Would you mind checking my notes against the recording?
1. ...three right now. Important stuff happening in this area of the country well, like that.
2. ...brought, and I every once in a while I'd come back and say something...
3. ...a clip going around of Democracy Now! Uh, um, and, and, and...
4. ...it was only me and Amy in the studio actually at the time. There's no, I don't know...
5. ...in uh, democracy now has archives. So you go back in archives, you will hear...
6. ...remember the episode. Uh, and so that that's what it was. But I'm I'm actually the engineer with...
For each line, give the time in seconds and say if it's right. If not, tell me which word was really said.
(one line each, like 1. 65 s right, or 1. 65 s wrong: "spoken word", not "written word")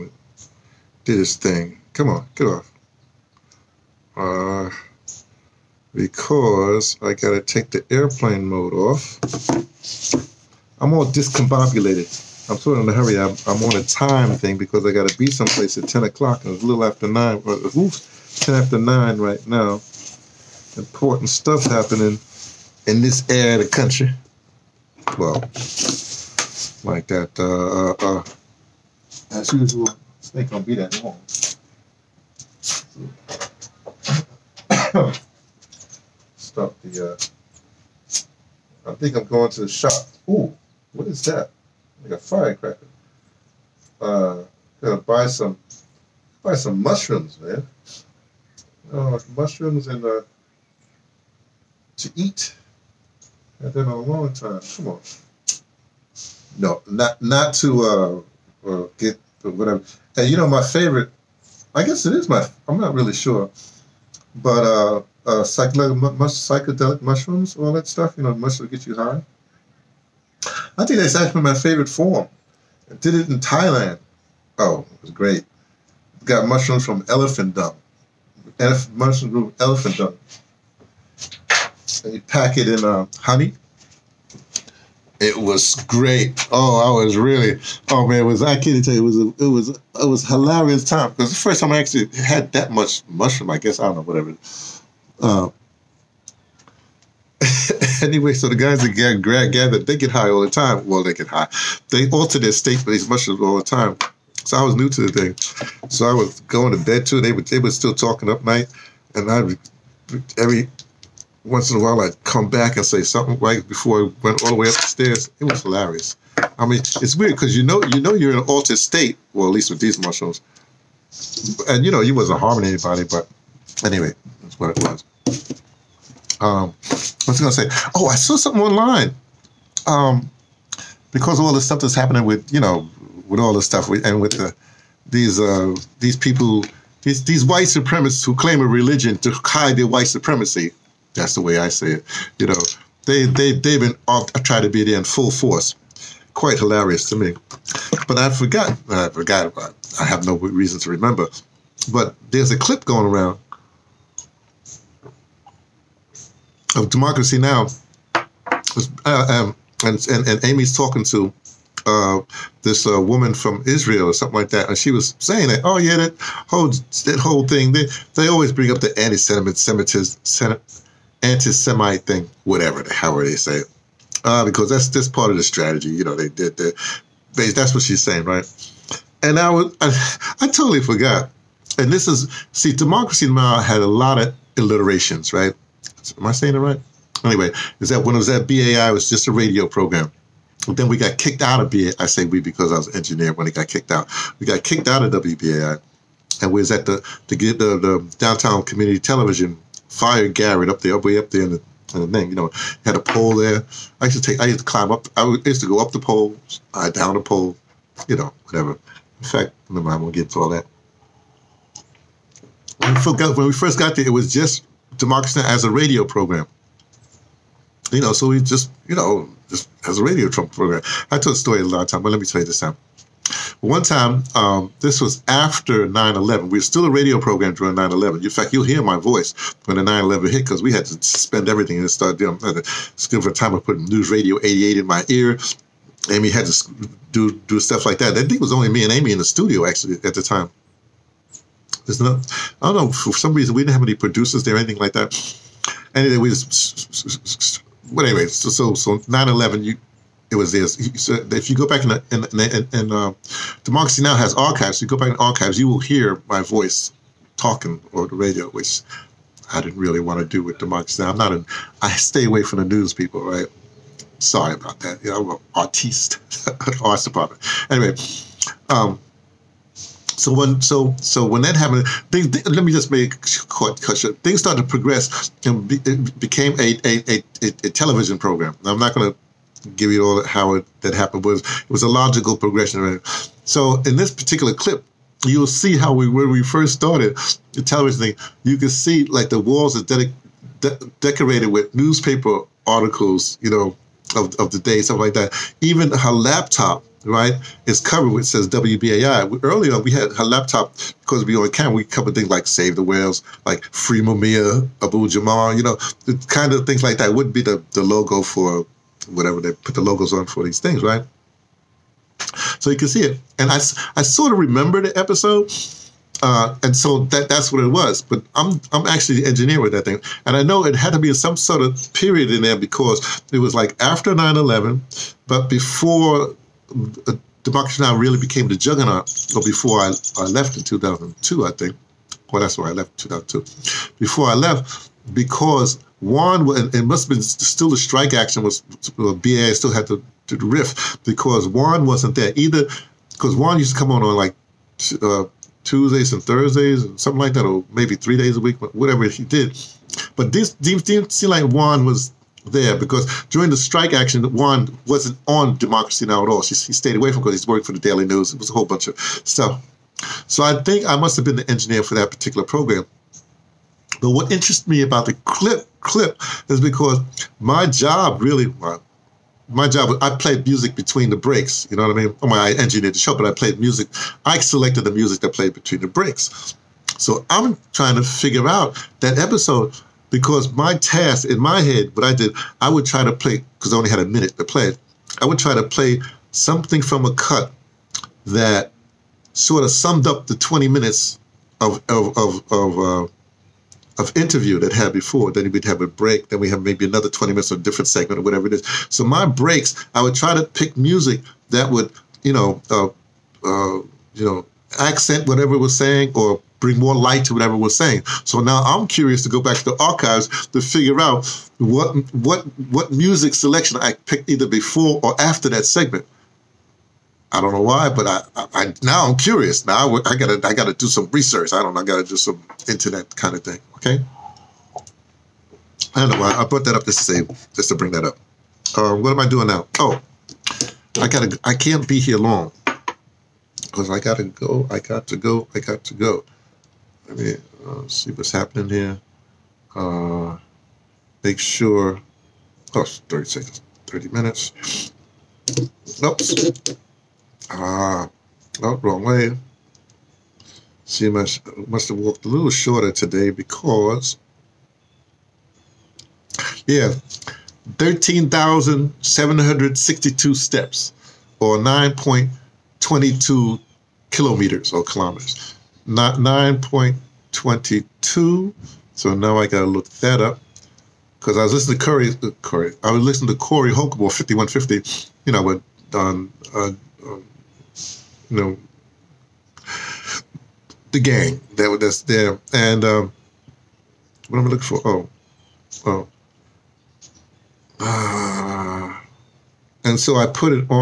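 1. 18 s wrong: "nine", not "three"
2. 108 s wrong: "night", not "brought"
3. 152 s right
4. 238 s right
5. 252 s right
6. 314 s right.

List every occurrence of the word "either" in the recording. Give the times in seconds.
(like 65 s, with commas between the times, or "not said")
342 s, 414 s.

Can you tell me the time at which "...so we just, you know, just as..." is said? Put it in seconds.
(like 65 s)
218 s.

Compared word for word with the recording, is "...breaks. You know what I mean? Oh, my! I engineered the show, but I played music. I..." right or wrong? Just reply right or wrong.
right.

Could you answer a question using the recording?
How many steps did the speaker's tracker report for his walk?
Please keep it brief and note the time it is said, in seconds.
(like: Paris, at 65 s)
13,762, at 457 s.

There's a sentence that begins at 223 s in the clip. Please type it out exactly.
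One time, um, this was after 9 11.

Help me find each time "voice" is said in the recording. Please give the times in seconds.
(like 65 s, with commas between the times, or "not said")
228 s, 256 s.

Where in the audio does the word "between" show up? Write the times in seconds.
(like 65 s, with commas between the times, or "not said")
370 s, 375 s.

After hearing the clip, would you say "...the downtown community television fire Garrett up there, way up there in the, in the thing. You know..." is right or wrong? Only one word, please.
right.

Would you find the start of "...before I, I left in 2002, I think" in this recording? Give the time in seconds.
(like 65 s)
329 s.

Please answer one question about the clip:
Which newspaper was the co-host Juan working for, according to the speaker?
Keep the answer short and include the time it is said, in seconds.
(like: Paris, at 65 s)
Daily News, at 357 s.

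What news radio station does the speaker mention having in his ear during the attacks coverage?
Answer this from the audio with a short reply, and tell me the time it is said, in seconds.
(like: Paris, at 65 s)
News Radio 88, at 233 s.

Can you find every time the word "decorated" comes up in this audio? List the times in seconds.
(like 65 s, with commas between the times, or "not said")
290 s.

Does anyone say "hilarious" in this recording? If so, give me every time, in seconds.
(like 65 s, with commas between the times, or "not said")
90 s, 115 s, 146 s.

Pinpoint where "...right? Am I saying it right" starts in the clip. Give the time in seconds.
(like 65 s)
185 s.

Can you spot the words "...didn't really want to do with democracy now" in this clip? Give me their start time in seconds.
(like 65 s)
259 s.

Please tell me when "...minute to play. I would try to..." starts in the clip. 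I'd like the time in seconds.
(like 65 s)
384 s.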